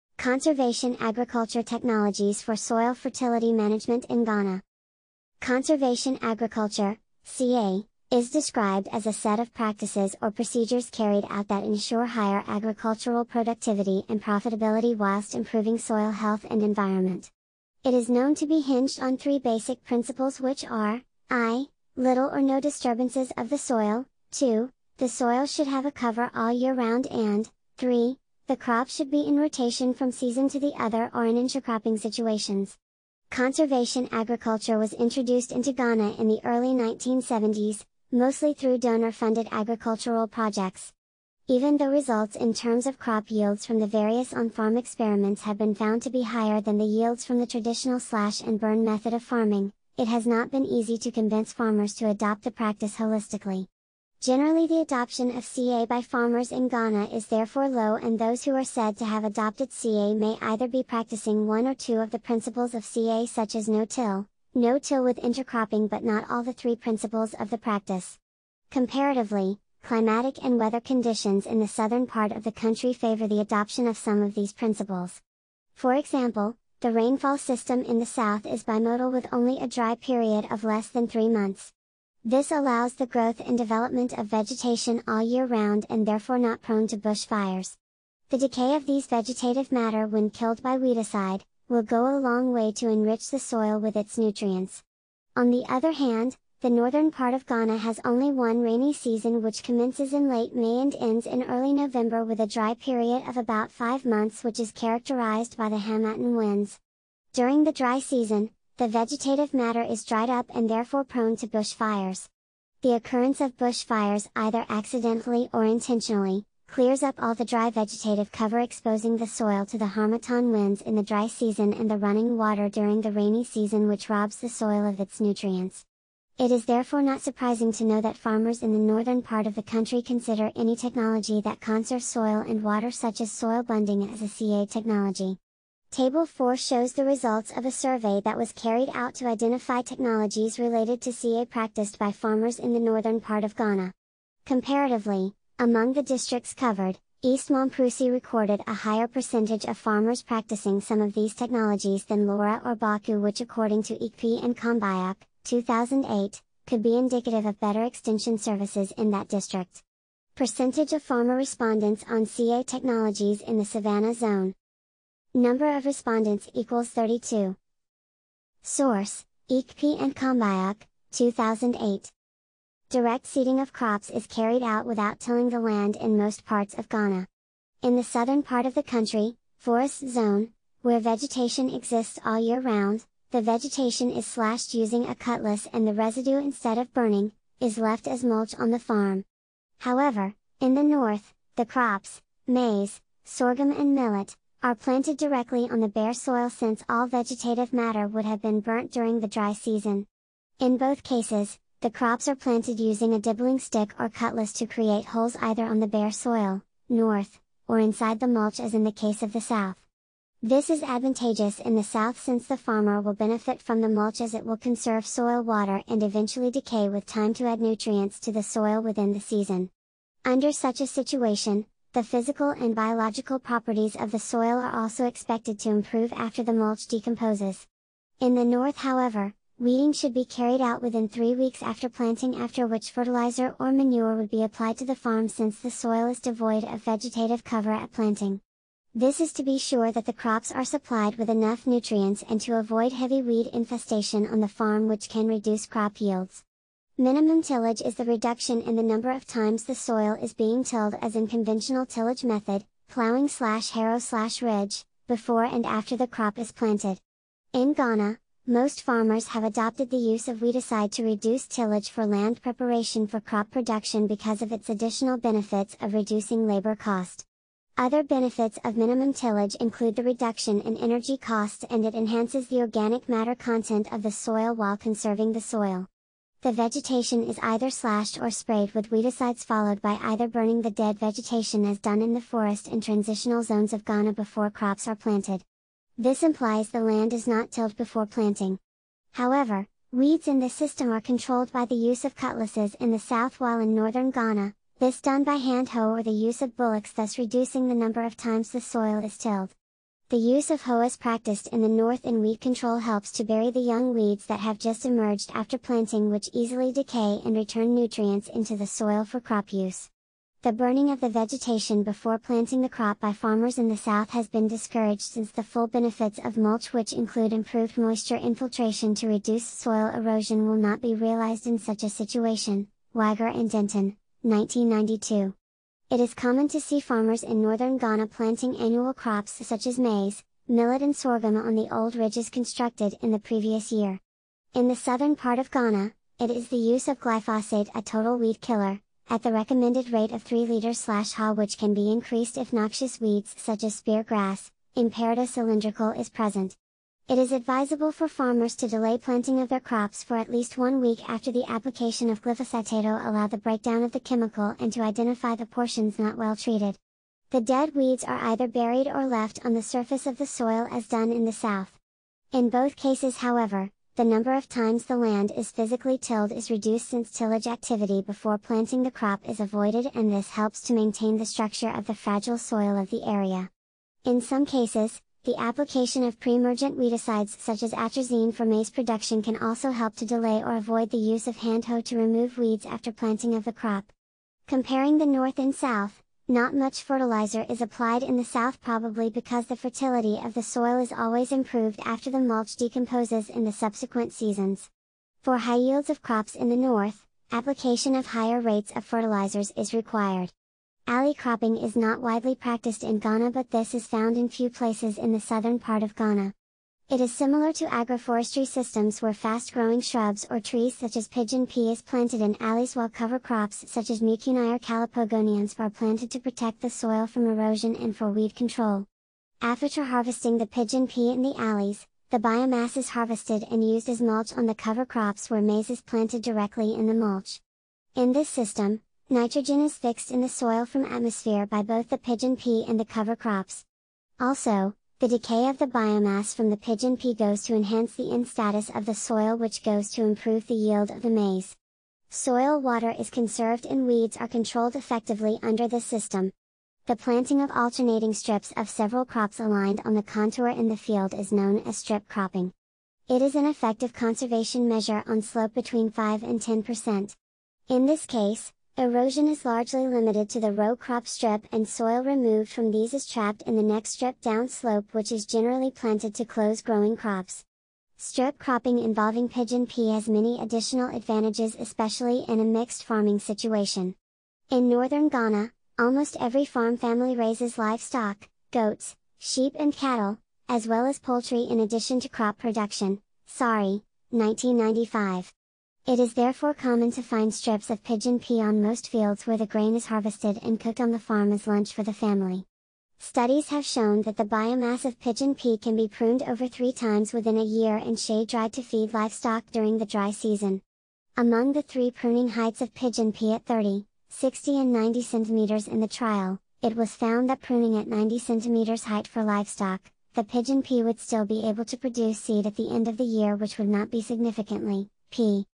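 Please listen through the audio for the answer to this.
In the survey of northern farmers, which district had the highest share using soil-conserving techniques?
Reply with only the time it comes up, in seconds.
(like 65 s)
147 s.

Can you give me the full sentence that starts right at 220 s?
Under such a situation, the physical and biological properties of the soil are also expected to improve after the mulch decomposes.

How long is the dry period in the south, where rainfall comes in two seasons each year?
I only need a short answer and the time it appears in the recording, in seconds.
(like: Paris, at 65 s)
less than three months, at 80 s.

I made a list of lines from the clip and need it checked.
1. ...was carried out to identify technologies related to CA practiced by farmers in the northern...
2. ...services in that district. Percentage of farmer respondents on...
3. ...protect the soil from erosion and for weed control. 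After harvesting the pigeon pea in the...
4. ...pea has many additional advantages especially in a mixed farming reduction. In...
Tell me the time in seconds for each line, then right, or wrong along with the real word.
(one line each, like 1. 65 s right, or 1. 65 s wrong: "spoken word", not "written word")
1. 138 s right
2. 158 s right
3. 416 s right
4. 469 s wrong: "situation", not "reduction".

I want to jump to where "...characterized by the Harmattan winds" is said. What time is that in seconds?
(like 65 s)
104 s.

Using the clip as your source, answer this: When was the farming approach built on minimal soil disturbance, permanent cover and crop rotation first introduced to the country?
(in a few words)
early 1970s.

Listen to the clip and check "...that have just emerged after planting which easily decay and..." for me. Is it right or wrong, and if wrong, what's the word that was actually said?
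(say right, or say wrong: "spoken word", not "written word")
right.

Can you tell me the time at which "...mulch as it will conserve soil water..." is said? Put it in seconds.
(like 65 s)
213 s.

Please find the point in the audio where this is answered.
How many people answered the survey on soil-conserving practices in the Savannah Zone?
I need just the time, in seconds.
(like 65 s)
166 s.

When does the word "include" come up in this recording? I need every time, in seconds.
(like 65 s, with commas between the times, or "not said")
269 s, 316 s.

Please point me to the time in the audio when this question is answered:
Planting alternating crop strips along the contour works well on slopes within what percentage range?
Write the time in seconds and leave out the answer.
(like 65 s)
455 s.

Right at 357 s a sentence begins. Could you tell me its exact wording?
The dead weeds are either buried or left on the surface of the soil as done in the south.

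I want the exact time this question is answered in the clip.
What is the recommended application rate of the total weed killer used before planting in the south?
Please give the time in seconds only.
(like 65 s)
340 s.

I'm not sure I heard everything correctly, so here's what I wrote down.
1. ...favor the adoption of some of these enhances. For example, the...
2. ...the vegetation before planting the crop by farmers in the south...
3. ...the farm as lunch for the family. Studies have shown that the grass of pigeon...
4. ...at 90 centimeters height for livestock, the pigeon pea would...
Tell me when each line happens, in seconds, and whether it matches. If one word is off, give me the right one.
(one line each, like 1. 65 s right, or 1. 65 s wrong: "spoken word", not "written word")
1. 72 s wrong: "principles", not "enhances"
2. 310 s right
3. 490 s wrong: "biomass", not "grass"
4. 507 s right.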